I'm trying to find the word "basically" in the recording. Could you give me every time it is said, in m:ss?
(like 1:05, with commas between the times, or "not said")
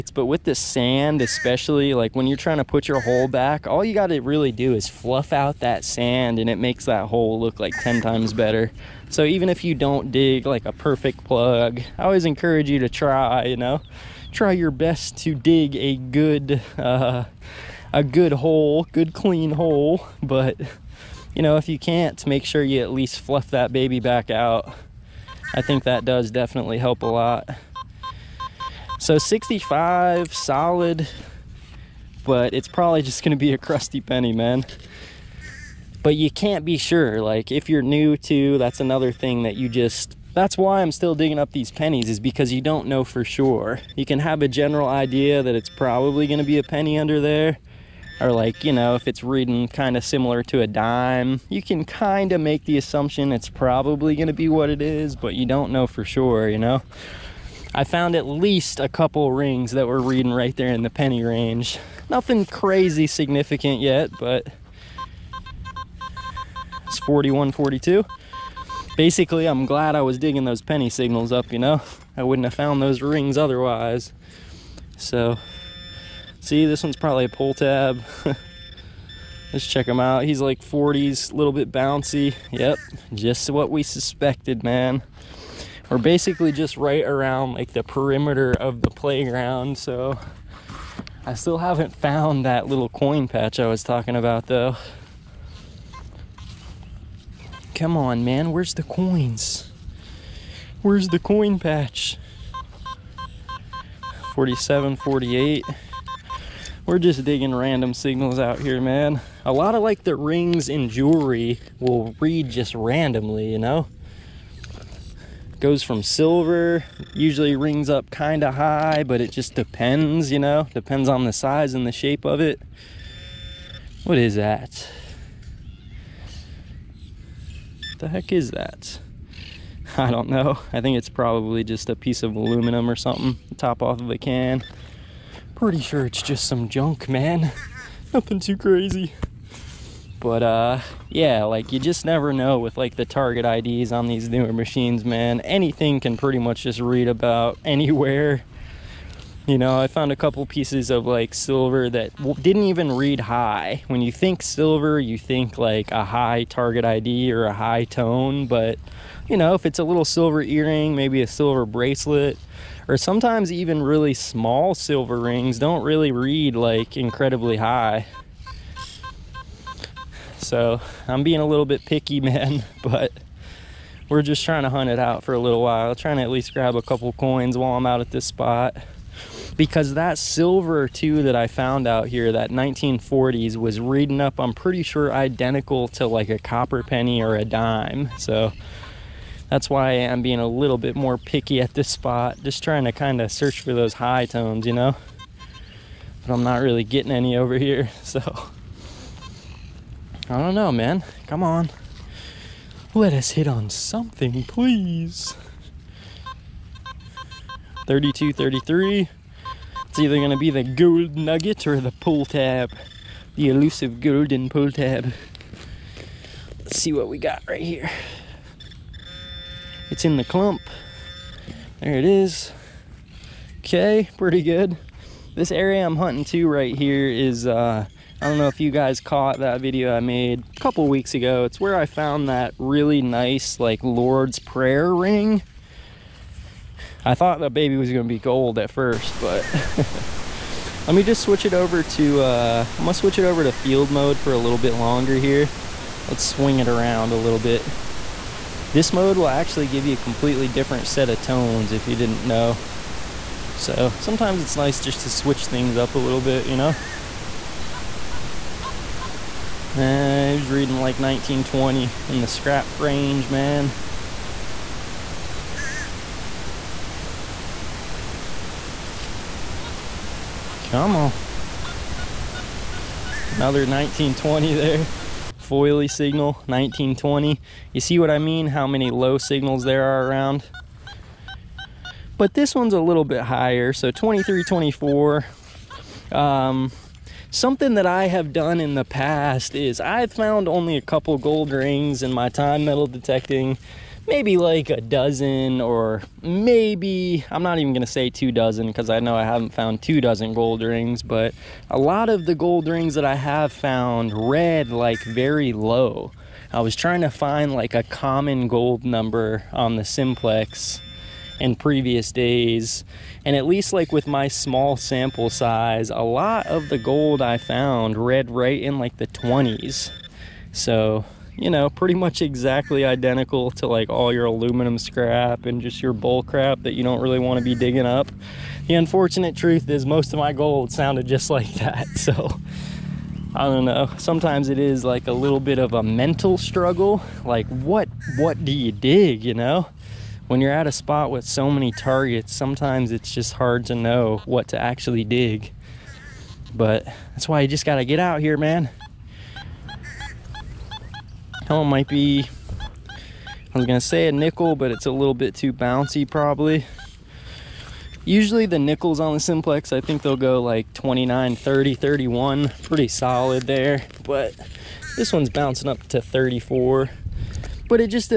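1:08, 1:25.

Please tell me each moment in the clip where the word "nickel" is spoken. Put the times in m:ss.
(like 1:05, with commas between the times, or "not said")
5:54, 5:58.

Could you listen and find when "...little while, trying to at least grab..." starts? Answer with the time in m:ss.
2:55.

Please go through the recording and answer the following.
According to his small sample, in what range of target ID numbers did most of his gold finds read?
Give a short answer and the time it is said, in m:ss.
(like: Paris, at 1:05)
The 20s, at 5:18.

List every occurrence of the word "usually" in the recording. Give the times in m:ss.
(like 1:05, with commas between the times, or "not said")
1:57, 5:58.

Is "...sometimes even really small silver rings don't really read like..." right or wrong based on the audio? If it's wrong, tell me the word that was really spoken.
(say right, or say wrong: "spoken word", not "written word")
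right.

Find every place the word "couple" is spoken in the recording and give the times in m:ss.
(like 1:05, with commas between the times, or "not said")
0:58, 2:30, 2:56, 3:50, 4:50.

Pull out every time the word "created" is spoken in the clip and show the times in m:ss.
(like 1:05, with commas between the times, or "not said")
not said.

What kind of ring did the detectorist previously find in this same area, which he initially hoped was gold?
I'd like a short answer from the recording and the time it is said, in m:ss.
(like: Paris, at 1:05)
Lord's Prayer ring, at 3:53.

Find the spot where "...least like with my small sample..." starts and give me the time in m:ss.
5:13.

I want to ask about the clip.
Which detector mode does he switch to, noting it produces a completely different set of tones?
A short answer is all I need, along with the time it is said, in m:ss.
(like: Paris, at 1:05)
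Field mode, at 4:03.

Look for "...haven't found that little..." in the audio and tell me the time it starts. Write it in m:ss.
1:31.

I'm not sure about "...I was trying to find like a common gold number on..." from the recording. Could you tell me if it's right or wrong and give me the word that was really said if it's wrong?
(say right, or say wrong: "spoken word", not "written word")
right.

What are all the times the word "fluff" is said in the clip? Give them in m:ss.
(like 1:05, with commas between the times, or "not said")
0:04, 0:23.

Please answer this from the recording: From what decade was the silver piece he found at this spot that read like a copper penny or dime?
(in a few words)
1940s.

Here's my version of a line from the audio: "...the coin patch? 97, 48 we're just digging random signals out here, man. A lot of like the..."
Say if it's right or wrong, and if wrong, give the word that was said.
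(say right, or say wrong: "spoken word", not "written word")
wrong: "47", not "97".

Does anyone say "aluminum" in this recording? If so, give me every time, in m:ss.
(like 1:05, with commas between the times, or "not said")
2:12, 5:24.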